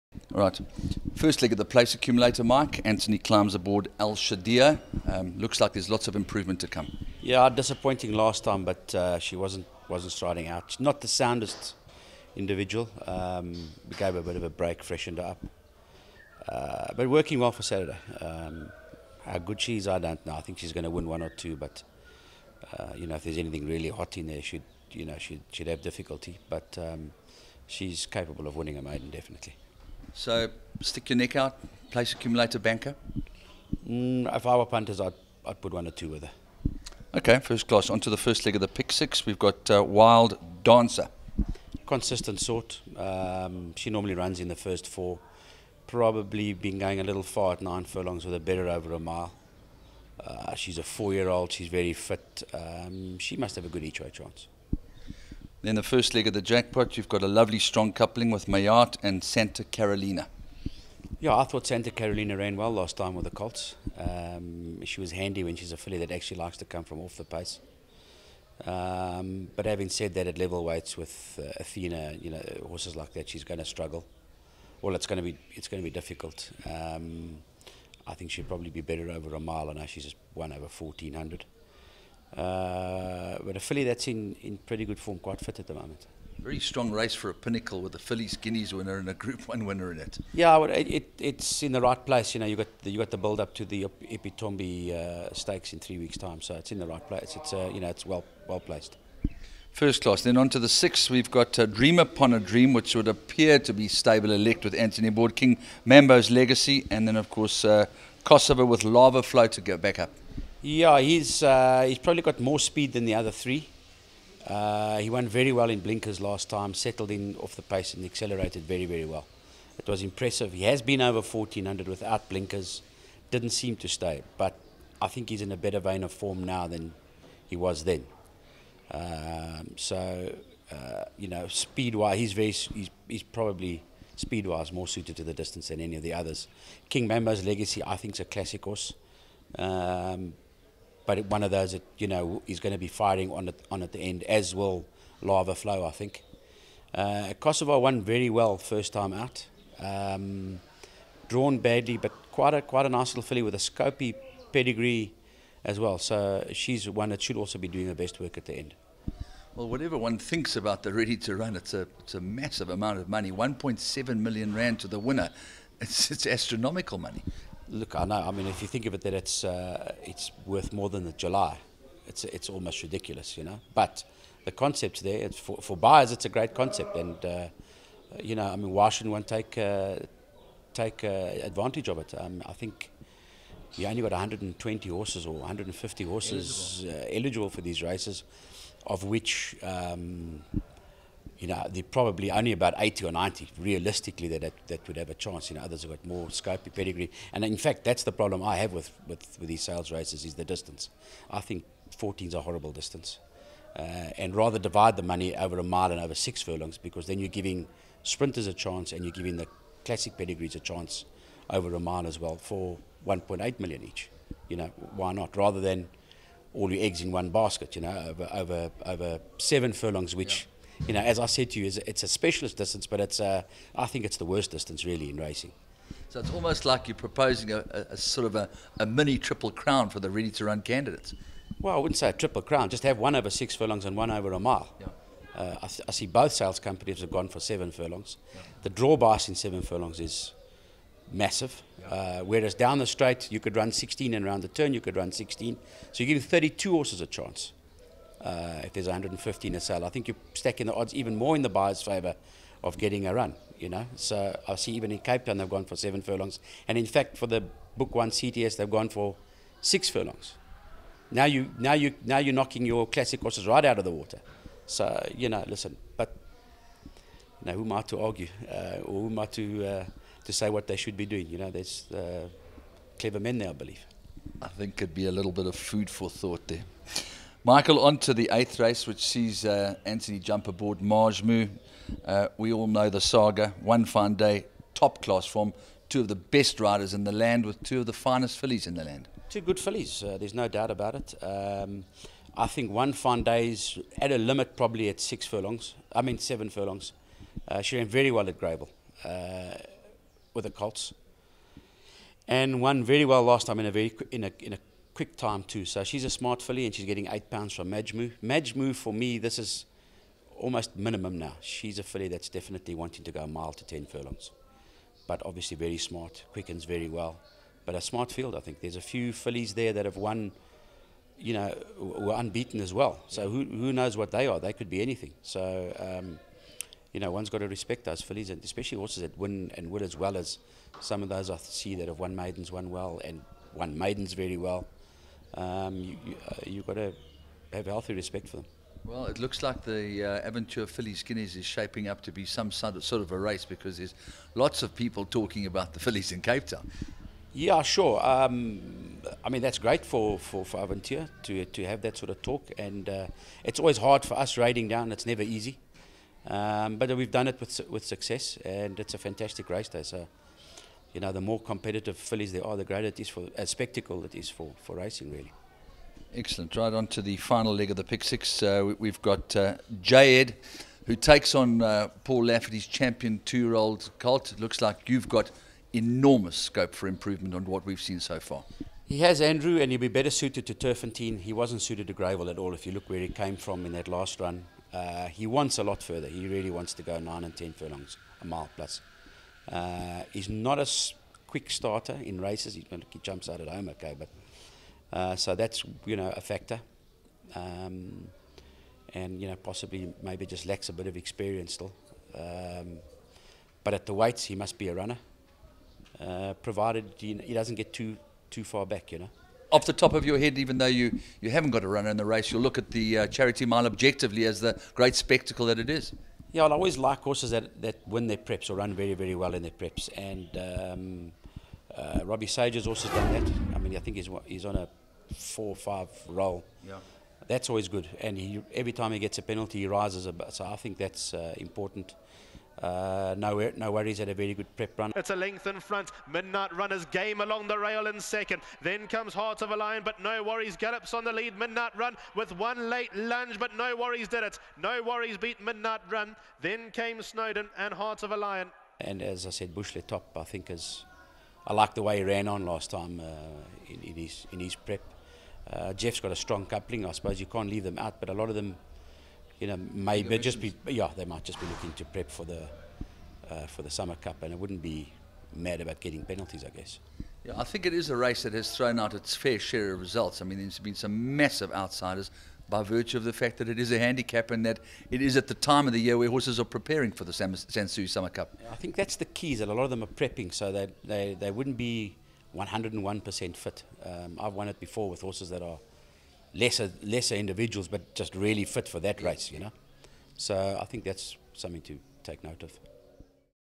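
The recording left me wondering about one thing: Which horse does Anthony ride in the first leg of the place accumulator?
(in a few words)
Al Shadia.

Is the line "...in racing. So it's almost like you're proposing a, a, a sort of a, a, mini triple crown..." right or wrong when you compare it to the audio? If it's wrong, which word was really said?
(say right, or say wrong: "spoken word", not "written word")
right.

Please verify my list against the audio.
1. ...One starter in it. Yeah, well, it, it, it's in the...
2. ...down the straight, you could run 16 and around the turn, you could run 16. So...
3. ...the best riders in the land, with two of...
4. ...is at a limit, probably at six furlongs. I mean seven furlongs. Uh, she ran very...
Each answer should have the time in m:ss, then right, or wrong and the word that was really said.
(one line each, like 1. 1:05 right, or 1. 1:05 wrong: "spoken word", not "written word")
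1. 1:29 wrong: "winner", not "starter"
2. 4:02 right
3. 4:46 right
4. 4:53 right.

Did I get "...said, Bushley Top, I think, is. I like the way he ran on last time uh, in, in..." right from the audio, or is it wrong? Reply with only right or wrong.
right.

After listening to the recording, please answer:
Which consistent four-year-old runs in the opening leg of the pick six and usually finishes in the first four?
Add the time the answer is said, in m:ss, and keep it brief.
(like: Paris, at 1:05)
Wild Dancer, at 0:39.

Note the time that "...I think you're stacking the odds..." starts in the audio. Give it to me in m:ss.
4:09.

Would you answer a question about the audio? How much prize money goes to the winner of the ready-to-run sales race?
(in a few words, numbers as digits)
1.7 million rand.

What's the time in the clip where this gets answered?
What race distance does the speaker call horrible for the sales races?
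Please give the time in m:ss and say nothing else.
3:21.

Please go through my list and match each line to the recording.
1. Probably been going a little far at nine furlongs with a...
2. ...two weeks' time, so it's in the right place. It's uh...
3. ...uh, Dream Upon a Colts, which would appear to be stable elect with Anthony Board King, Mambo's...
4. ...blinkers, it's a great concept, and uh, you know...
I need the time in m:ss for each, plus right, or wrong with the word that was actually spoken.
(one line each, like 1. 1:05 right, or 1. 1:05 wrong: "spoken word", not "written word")
1. 0:45 right
2. 1:35 wrong: "three", not "two"
3. 1:41 wrong: "Dream", not "Colts"
4. 2:55 wrong: "buyers", not "blinkers".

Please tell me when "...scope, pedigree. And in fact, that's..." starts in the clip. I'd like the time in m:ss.
3:16.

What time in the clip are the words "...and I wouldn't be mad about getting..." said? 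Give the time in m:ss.
7:44.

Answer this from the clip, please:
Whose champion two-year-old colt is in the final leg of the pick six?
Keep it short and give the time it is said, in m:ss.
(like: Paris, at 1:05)
Paul Lafferty, at 6:12.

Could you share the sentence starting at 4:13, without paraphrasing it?
So I see even in Cape Town they've gone for seven furlongs.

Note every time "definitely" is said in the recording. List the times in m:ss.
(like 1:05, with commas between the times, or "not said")
0:29, 5:12.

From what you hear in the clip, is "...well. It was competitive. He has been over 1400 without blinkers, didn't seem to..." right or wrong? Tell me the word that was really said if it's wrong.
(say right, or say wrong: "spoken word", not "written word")
wrong: "impressive", not "competitive".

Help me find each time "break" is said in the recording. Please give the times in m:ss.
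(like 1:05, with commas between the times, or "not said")
0:14.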